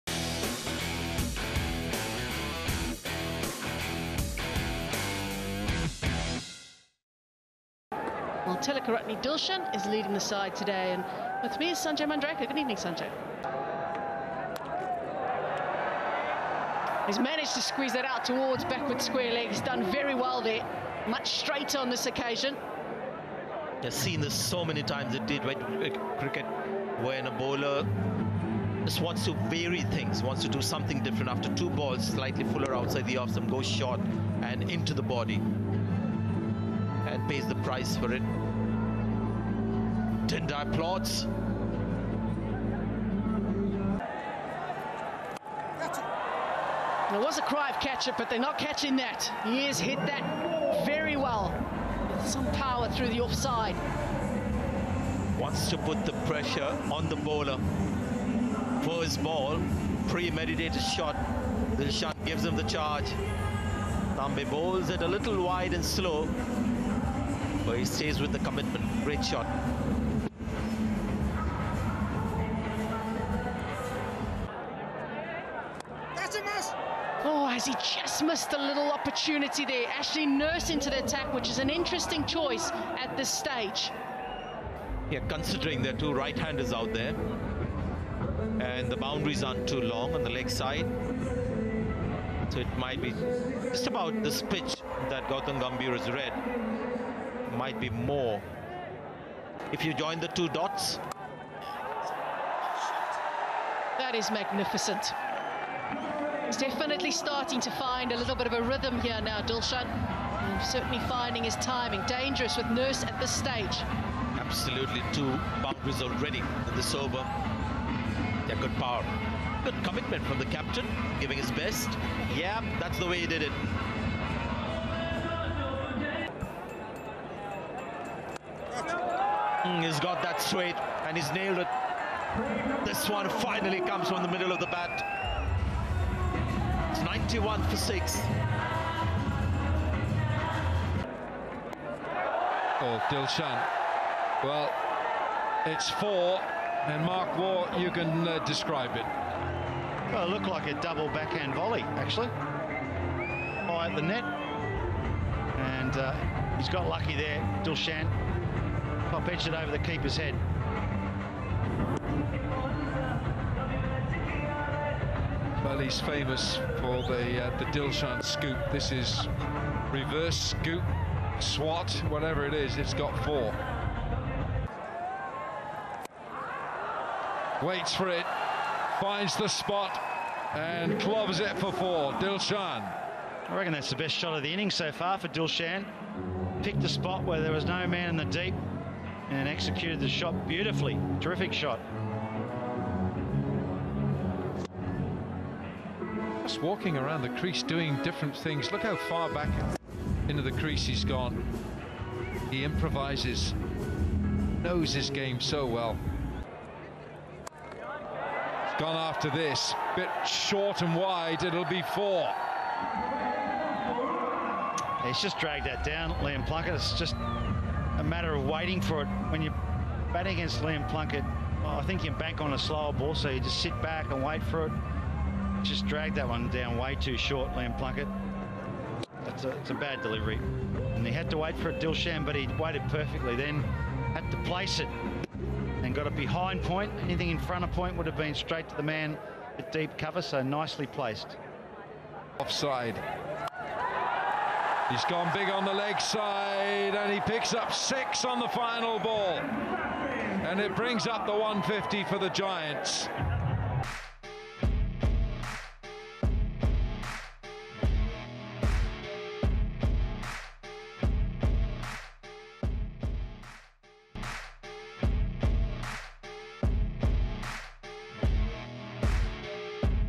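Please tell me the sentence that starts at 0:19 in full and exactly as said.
He's done very well there, much straighter on this occasion.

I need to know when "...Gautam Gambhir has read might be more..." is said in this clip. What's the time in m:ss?
1:35.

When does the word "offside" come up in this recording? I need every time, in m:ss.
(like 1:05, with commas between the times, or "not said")
0:53, 4:02.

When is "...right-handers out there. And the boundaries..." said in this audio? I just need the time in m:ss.
1:26.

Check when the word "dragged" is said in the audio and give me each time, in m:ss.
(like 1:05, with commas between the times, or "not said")
3:35, 3:45.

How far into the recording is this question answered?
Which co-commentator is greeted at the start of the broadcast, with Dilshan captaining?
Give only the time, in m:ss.
0:11.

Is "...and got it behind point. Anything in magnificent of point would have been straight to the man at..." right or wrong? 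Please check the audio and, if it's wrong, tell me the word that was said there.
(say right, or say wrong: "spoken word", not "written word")
wrong: "front", not "magnificent".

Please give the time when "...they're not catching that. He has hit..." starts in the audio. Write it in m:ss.
0:48.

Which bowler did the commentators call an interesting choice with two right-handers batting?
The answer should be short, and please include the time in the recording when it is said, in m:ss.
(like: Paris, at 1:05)
Ashley Nurse, at 1:19.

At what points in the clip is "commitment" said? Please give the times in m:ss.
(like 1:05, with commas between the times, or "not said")
1:08, 1:59.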